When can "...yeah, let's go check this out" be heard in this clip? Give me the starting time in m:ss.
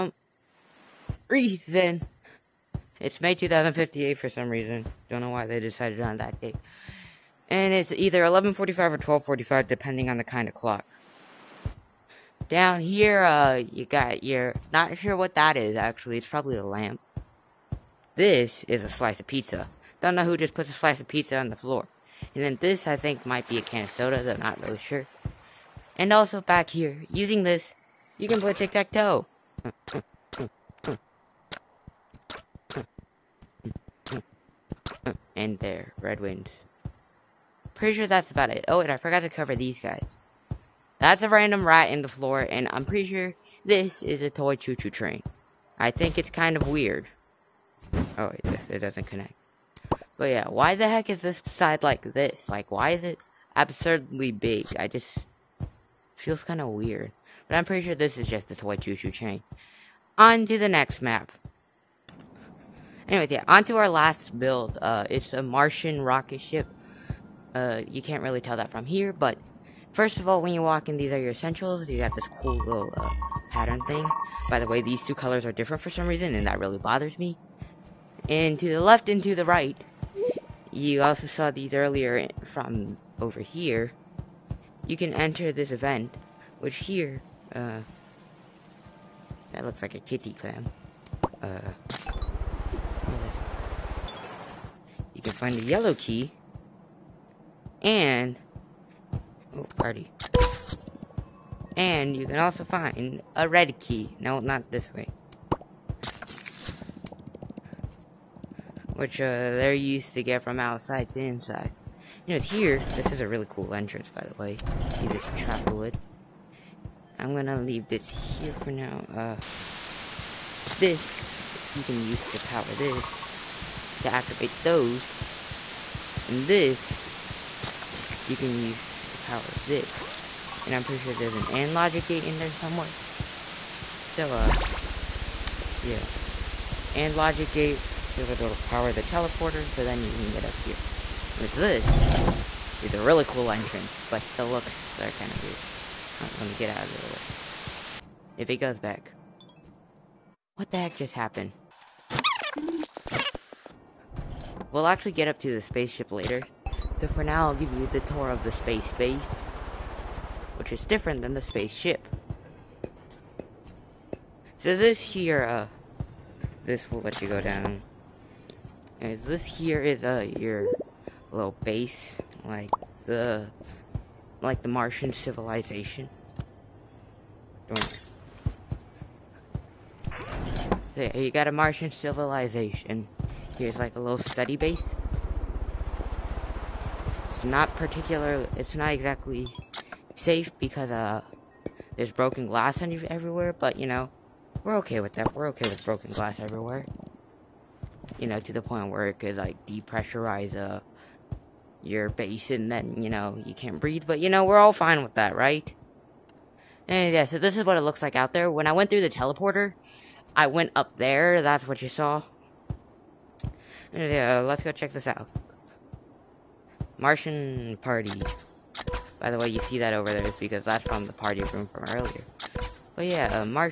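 3:34.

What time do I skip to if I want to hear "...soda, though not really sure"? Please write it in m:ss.
0:23.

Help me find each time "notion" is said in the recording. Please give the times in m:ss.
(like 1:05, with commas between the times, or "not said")
not said.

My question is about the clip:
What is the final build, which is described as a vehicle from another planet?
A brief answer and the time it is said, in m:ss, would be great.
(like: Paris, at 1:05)
Martian rocket ship, at 1:05.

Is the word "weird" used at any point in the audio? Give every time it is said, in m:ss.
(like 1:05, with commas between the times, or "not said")
0:46, 0:56, 2:25.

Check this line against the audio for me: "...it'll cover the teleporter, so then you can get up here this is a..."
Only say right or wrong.
wrong.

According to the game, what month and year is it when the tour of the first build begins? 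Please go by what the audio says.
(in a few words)
May 2058.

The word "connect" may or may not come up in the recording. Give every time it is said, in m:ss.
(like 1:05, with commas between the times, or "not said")
0:49.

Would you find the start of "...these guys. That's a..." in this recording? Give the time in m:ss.
0:39.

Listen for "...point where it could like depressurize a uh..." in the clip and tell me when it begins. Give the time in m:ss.
3:18.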